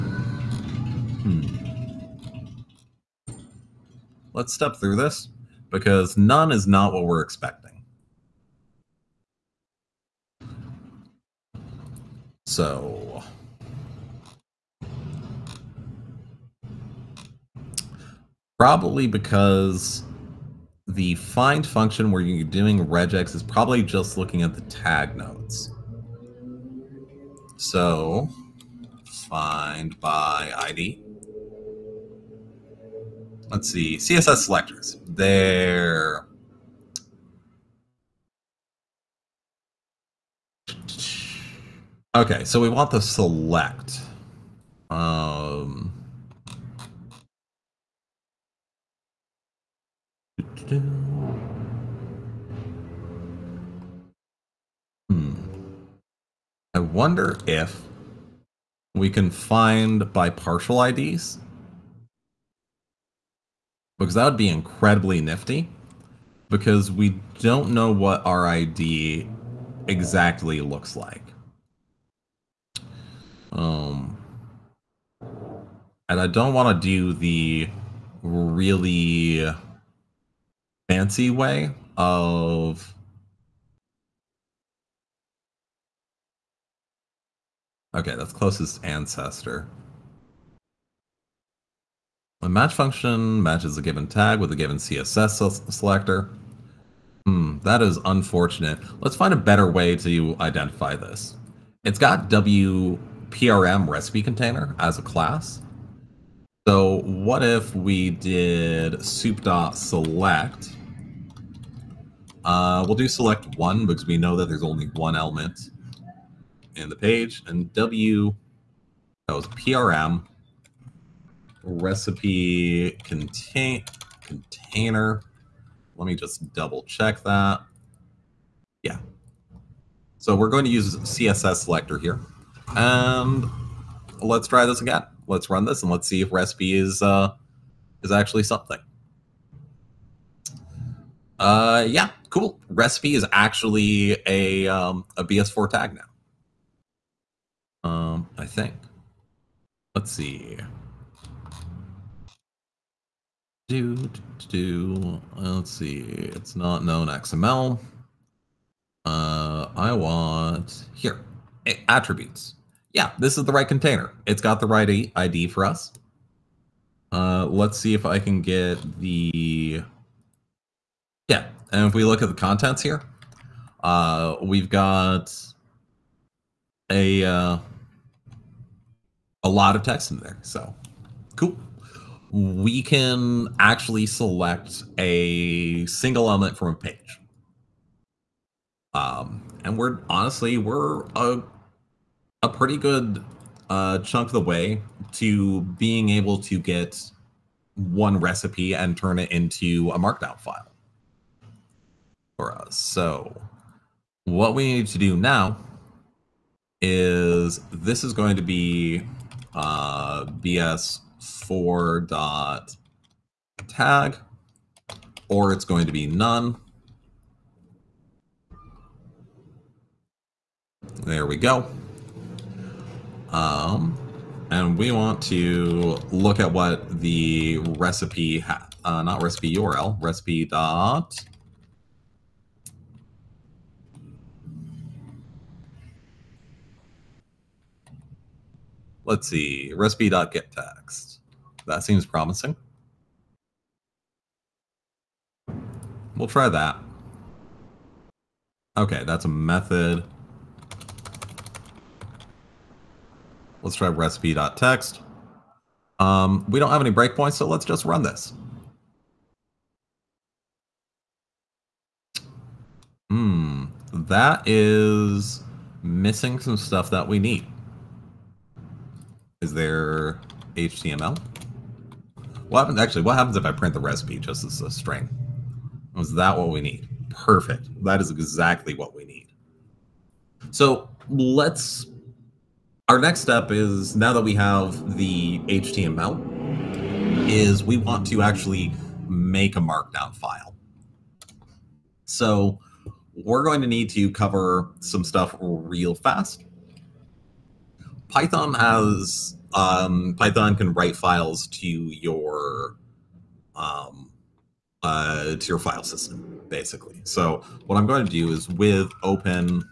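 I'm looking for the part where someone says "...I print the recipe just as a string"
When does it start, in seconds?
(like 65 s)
273 s.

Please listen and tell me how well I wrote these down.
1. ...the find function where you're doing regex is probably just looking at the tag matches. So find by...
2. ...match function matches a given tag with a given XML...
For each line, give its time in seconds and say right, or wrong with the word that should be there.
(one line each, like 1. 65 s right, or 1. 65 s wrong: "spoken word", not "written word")
1. 20 s wrong: "nodes", not "matches"
2. 92 s wrong: "CSS", not "XML".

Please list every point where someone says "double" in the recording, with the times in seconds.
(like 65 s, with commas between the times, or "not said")
126 s.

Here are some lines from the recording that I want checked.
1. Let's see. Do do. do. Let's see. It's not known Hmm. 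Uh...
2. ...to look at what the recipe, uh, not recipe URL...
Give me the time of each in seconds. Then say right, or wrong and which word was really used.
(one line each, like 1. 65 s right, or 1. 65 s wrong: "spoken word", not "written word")
1. 149 s wrong: "XML", not "Hmm"
2. 225 s right.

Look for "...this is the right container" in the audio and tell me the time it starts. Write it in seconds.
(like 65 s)
163 s.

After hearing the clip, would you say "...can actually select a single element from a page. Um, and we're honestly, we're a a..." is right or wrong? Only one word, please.
right.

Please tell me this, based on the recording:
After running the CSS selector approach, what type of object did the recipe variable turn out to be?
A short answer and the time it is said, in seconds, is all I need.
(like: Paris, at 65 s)
BS4 tag, at 145 s.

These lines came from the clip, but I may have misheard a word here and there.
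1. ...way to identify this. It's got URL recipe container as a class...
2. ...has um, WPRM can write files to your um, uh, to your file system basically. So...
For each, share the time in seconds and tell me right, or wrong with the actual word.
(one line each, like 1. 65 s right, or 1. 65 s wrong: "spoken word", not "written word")
1. 99 s wrong: "WPRM", not "URL"
2. 298 s wrong: "Python", not "WPRM".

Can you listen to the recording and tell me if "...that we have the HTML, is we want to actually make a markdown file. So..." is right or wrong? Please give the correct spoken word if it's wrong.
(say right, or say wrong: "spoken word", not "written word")
right.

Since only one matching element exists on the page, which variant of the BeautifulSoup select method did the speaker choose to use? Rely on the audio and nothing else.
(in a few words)
select one.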